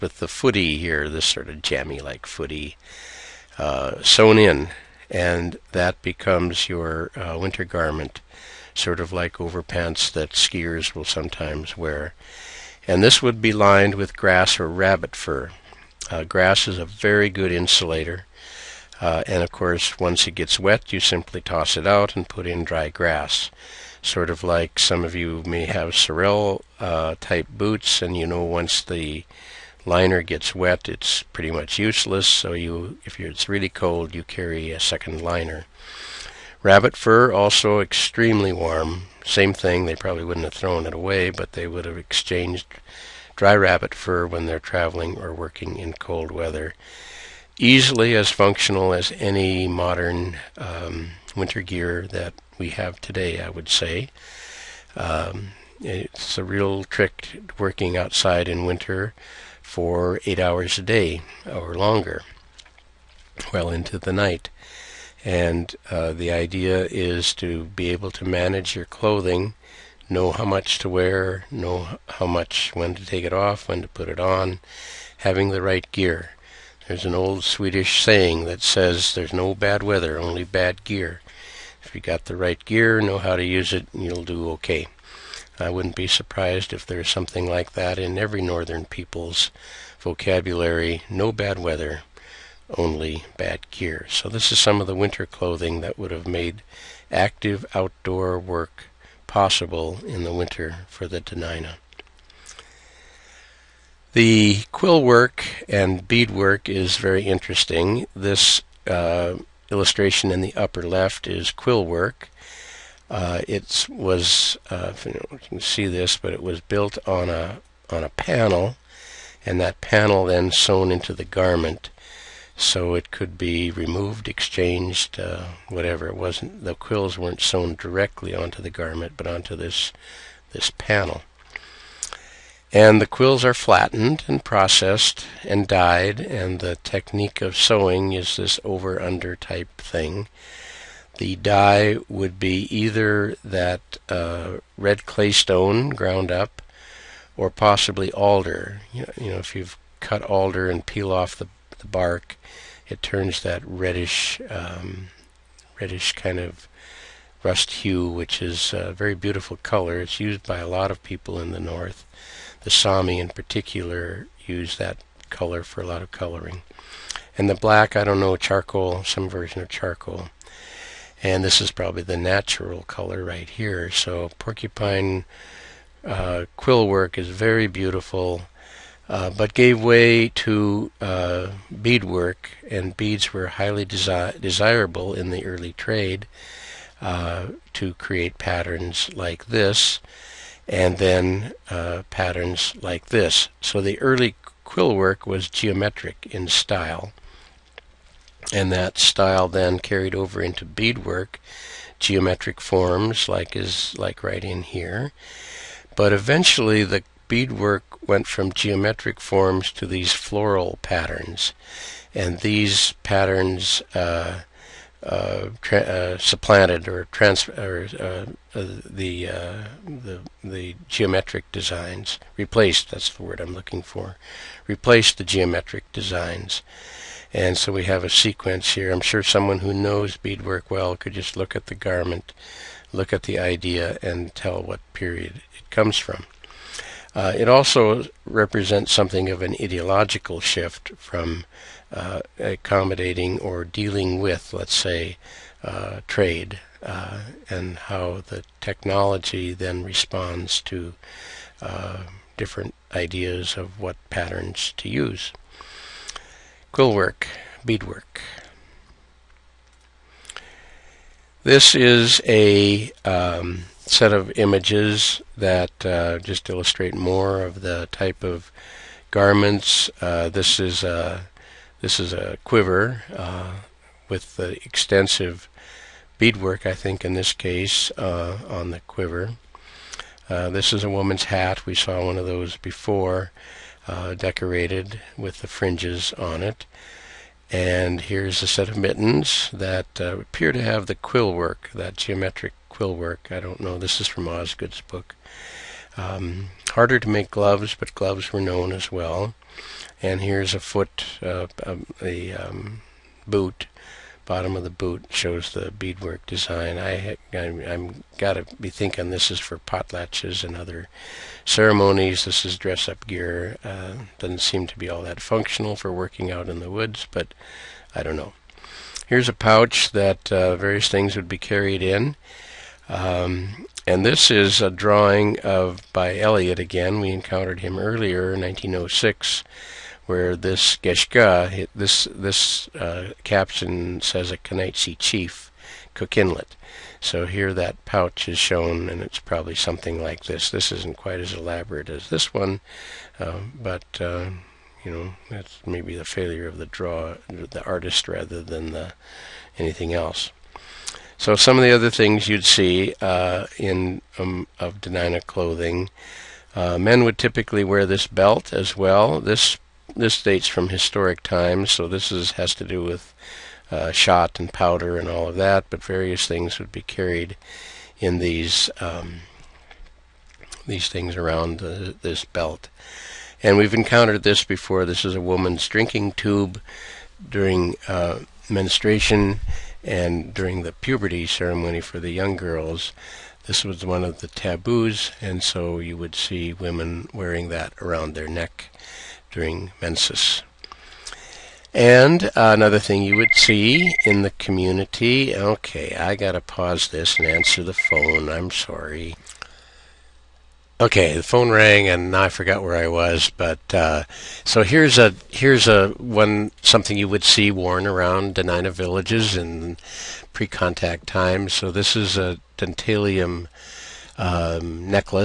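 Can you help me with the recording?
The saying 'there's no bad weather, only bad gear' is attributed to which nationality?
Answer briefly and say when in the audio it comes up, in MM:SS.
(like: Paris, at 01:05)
Swedish, at 01:17.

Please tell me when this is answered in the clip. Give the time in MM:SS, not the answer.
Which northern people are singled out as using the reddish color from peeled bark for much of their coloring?
02:42.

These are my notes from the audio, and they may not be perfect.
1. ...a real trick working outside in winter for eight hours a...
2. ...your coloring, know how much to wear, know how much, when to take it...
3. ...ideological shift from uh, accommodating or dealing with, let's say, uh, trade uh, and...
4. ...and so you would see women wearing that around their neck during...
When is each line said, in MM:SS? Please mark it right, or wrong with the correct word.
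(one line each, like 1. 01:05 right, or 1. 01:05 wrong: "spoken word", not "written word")
1. 00:56 right
2. 01:08 wrong: "clothing", not "coloring"
3. 03:59 right
4. 06:25 right.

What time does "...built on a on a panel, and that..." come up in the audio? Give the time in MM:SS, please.
01:56.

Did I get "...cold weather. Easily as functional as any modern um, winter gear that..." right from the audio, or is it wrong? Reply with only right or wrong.
right.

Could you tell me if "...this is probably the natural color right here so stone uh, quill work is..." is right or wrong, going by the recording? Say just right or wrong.
wrong.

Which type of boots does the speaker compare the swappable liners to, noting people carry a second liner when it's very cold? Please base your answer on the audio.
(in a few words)
Sorel.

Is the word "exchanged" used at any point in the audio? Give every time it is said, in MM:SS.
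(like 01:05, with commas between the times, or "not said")
00:41, 02:04.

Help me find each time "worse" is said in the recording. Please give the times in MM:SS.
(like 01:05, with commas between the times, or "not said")
not said.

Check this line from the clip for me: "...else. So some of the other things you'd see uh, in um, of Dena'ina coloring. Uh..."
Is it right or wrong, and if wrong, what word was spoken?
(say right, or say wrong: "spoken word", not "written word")
wrong: "clothing", not "coloring".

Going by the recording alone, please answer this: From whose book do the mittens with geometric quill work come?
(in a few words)
Osgood.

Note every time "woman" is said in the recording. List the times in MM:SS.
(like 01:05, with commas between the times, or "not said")
04:40, 06:15.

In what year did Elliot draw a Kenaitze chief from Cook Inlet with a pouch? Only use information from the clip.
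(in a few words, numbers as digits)
1906.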